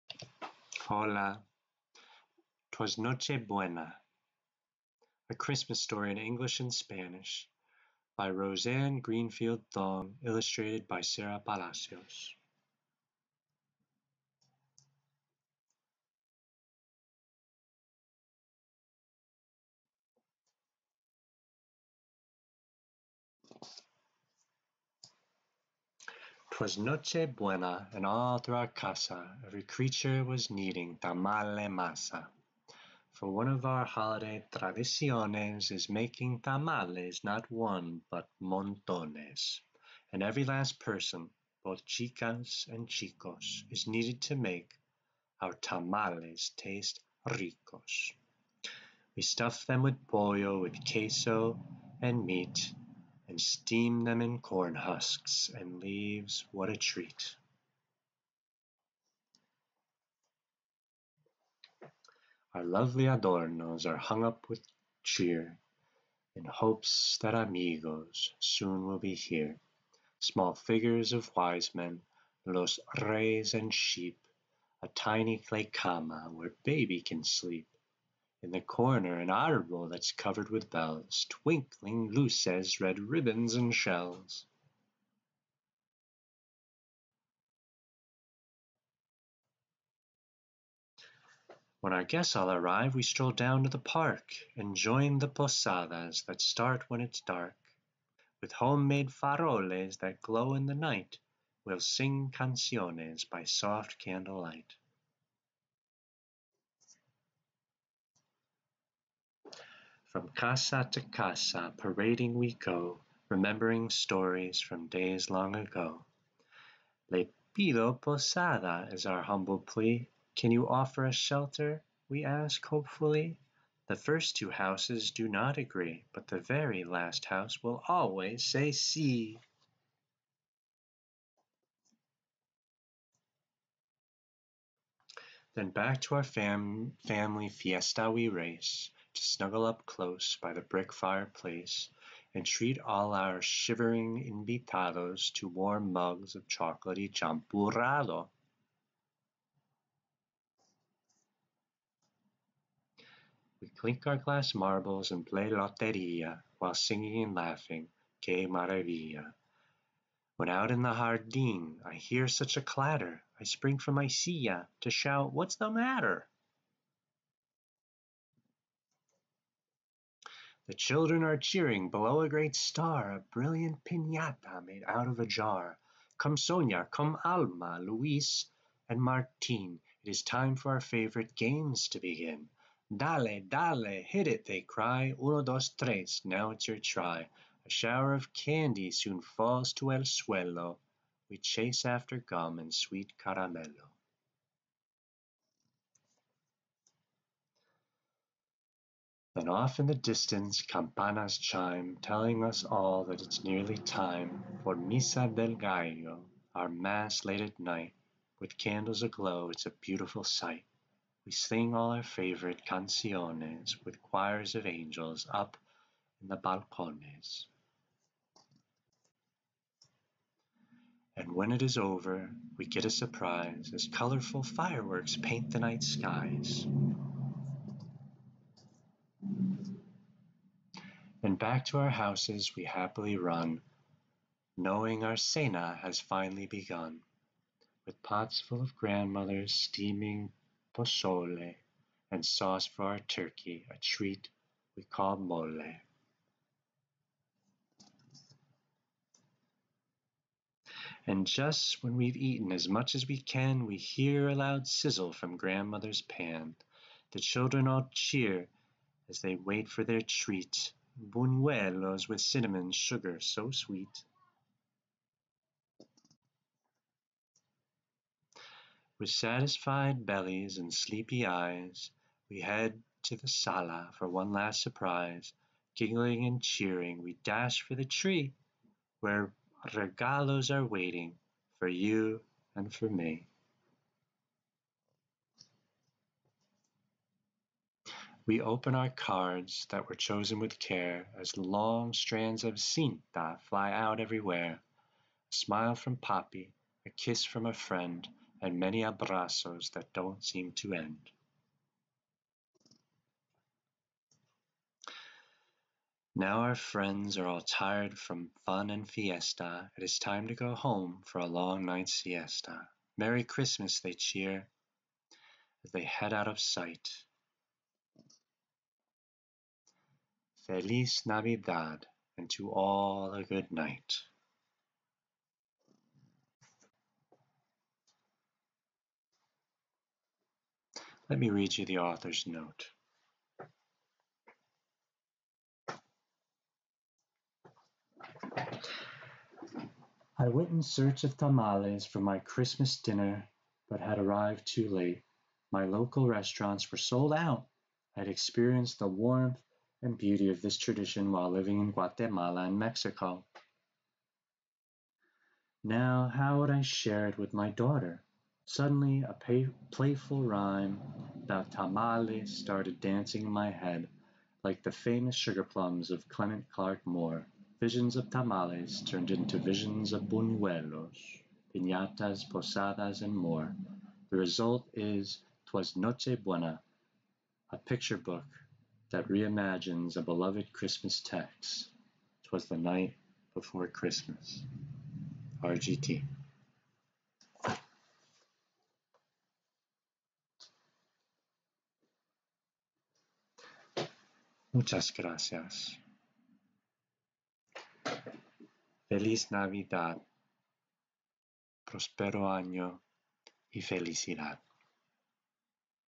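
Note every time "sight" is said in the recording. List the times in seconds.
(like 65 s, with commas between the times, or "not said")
210 s, 316 s.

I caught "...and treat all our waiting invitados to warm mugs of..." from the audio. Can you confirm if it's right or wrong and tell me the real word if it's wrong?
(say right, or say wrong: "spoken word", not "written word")
wrong: "shivering", not "waiting".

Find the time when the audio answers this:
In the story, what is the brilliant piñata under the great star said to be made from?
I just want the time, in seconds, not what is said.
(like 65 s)
175 s.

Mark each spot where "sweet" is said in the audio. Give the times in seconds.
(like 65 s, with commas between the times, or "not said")
192 s, 263 s.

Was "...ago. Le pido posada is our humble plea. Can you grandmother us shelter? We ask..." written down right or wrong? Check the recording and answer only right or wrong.
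wrong.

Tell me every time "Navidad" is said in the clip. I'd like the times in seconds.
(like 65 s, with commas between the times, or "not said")
321 s, 399 s.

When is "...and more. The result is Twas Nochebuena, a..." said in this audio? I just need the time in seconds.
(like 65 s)
373 s.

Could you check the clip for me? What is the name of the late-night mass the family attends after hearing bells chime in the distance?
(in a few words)
Misa del Gallo.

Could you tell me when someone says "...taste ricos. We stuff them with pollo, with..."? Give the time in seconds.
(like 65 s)
46 s.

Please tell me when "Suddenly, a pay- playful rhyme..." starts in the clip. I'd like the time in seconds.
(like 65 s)
358 s.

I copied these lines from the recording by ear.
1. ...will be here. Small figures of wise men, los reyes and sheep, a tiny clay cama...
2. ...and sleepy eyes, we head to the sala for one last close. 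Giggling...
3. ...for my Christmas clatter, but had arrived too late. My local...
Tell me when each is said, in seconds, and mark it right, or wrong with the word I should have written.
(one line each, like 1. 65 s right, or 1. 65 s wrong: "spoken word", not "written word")
1. 68 s right
2. 270 s wrong: "surprise", not "close"
3. 341 s wrong: "dinner", not "clatter".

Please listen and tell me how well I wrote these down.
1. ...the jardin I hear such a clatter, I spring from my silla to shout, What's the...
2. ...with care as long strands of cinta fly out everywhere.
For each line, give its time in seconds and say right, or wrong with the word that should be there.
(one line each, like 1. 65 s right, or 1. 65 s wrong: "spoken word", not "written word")
1. 160 s right
2. 290 s right.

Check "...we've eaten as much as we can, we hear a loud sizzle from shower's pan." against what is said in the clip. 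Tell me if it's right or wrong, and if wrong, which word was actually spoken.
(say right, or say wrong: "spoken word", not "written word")
wrong: "grandmother", not "shower".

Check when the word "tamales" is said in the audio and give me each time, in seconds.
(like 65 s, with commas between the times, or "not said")
30 s, 36 s, 45 s, 341 s, 361 s, 368 s.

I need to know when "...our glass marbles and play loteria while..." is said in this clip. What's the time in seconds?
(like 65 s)
154 s.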